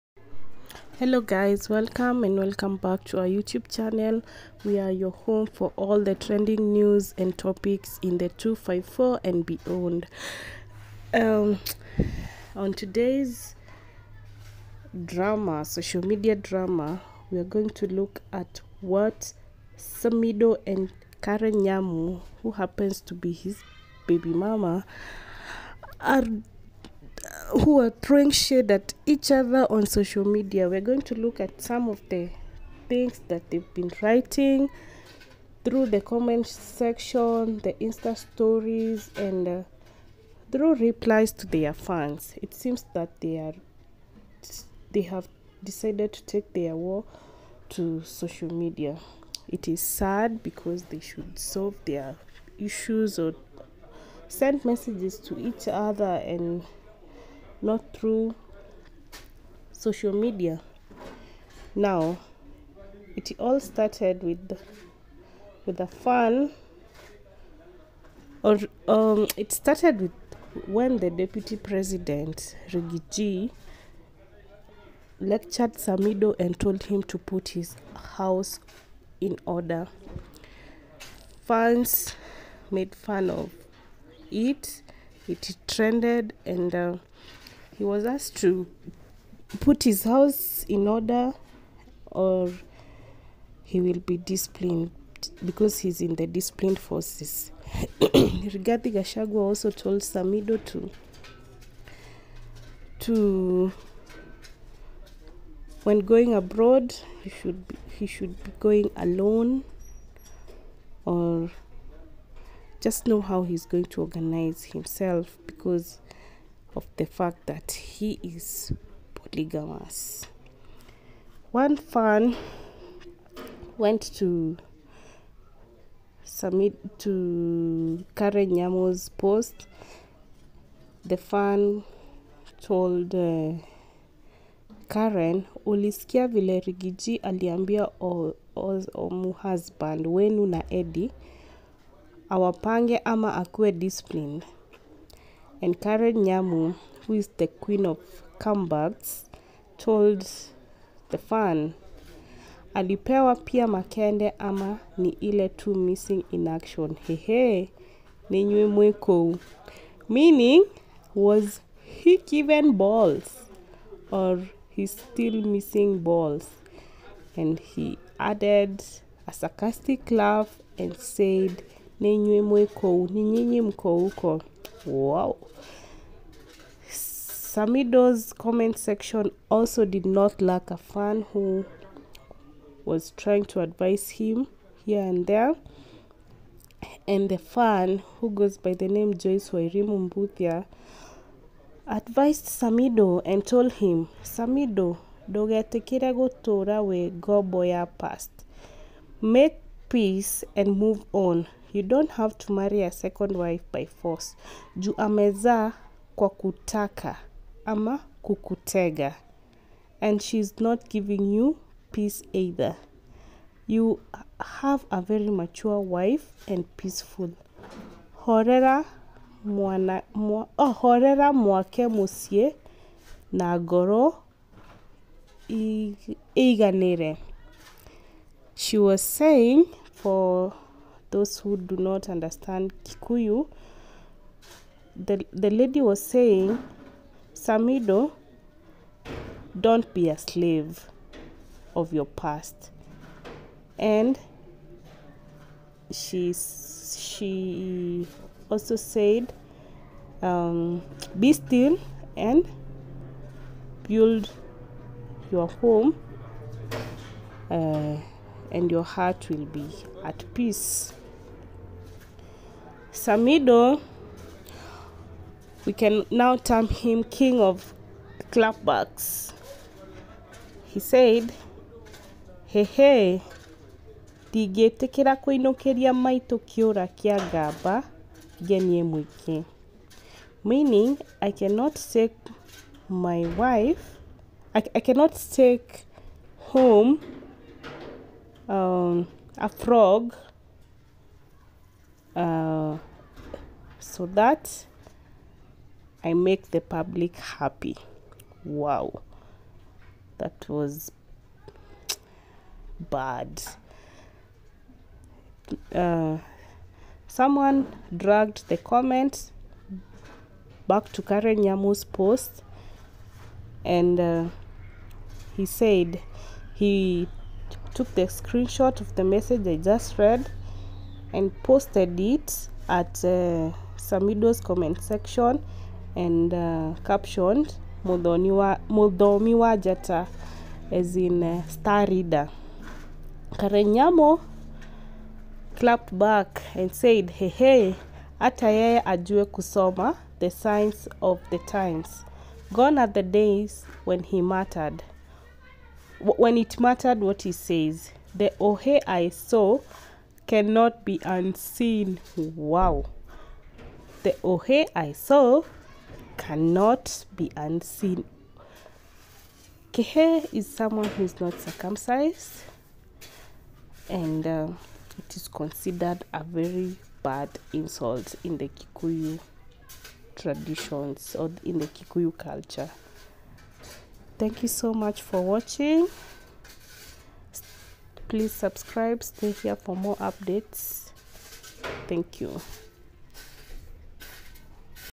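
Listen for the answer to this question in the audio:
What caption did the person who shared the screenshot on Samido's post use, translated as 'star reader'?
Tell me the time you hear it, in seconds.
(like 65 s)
327 s.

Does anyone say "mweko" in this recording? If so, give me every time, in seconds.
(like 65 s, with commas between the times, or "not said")
158 s, 172 s.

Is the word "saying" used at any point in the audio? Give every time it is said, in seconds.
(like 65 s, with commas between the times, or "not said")
229 s, 236 s.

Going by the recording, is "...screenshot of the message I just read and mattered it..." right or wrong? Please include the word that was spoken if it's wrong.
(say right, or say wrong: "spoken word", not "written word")
wrong: "posted", not "mattered".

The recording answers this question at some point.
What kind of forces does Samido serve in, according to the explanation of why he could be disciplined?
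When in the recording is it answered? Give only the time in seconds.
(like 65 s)
96 s.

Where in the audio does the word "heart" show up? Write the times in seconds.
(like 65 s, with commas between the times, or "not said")
258 s.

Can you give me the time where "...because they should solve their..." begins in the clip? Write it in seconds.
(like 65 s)
50 s.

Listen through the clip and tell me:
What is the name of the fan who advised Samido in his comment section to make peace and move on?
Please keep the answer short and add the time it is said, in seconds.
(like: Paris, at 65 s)
Joyce Wairimu Mbuthia, at 189 s.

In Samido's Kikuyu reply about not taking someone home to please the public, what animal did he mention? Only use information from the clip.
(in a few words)
frog.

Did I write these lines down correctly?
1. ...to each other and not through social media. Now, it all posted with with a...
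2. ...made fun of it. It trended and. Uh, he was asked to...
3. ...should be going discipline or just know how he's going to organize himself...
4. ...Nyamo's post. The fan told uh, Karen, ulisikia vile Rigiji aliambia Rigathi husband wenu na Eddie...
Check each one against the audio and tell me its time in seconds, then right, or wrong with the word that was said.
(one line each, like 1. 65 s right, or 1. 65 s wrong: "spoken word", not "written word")
1. 55 s wrong: "started", not "posted"
2. 82 s right
3. 108 s wrong: "alone", not "discipline"
4. 128 s wrong: "Omu", not "Rigathi".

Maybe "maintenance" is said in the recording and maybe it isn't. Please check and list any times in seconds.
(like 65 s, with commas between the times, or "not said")
not said.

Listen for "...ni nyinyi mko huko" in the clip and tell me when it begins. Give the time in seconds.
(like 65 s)
173 s.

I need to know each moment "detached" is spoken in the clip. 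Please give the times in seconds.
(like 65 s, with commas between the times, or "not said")
not said.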